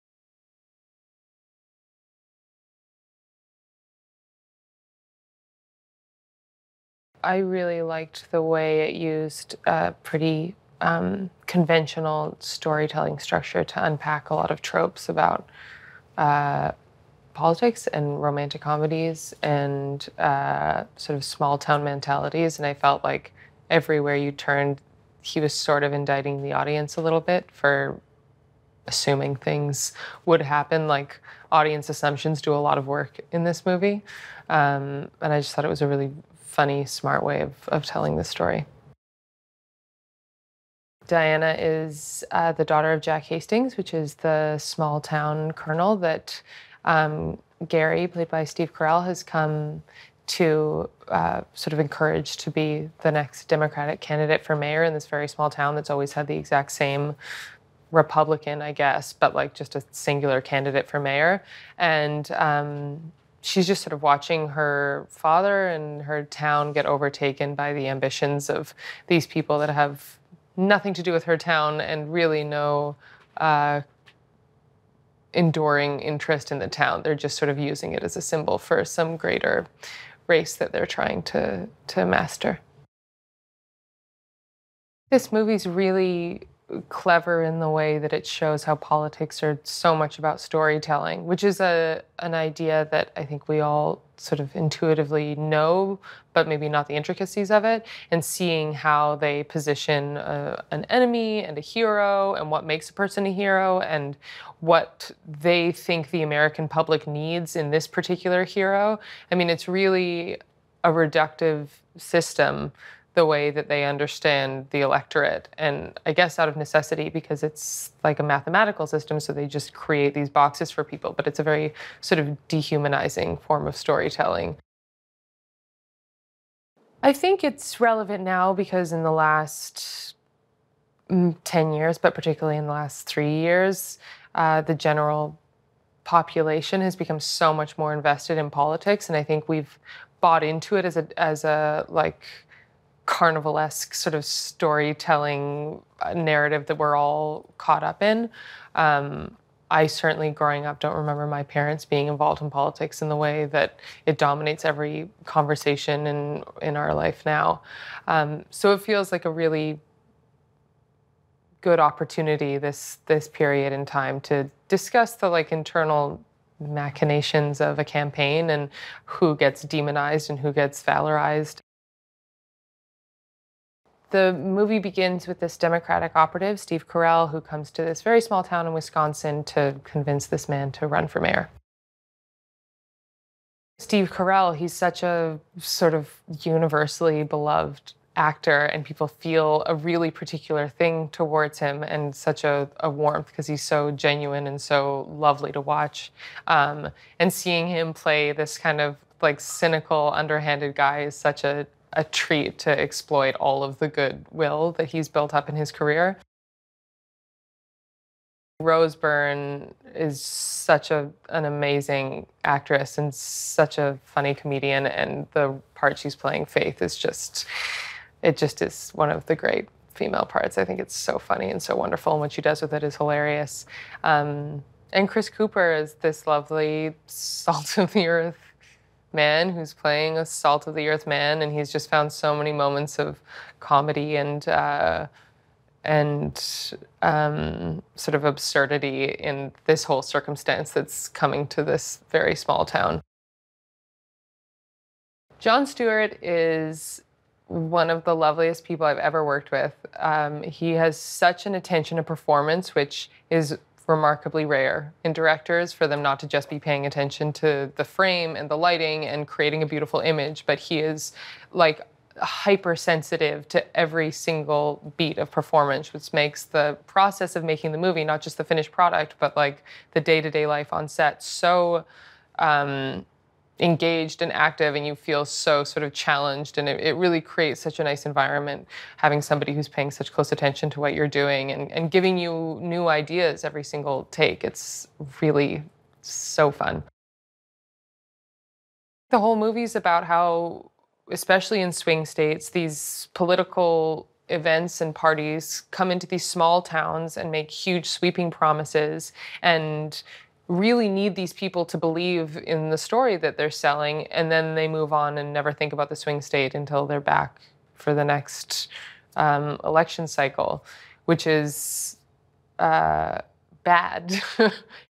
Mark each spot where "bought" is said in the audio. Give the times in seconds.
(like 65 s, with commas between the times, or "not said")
140 s.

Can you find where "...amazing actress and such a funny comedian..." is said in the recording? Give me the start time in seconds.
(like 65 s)
211 s.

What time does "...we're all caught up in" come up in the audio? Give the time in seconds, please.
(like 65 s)
146 s.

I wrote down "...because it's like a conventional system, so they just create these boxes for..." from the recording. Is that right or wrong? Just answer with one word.
wrong.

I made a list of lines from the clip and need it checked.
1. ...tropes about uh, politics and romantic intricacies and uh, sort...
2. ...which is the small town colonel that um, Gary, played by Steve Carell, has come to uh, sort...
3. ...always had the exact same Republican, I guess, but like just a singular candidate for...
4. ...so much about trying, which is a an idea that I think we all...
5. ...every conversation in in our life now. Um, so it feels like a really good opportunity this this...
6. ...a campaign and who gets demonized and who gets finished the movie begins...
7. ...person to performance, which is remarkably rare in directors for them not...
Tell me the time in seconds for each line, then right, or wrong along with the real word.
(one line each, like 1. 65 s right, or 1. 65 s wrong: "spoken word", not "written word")
1. 14 s wrong: "comedies", not "intricacies"
2. 43 s right
3. 55 s right
4. 89 s wrong: "storytelling", not "trying"
5. 154 s right
6. 167 s wrong: "valorized", not "finished"
7. 251 s wrong: "attention", not "person".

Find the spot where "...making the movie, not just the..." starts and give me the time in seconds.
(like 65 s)
267 s.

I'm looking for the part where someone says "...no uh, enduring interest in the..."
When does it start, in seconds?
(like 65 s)
72 s.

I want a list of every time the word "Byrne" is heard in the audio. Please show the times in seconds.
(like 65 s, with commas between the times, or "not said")
208 s.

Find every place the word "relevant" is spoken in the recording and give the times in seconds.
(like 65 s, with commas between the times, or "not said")
127 s.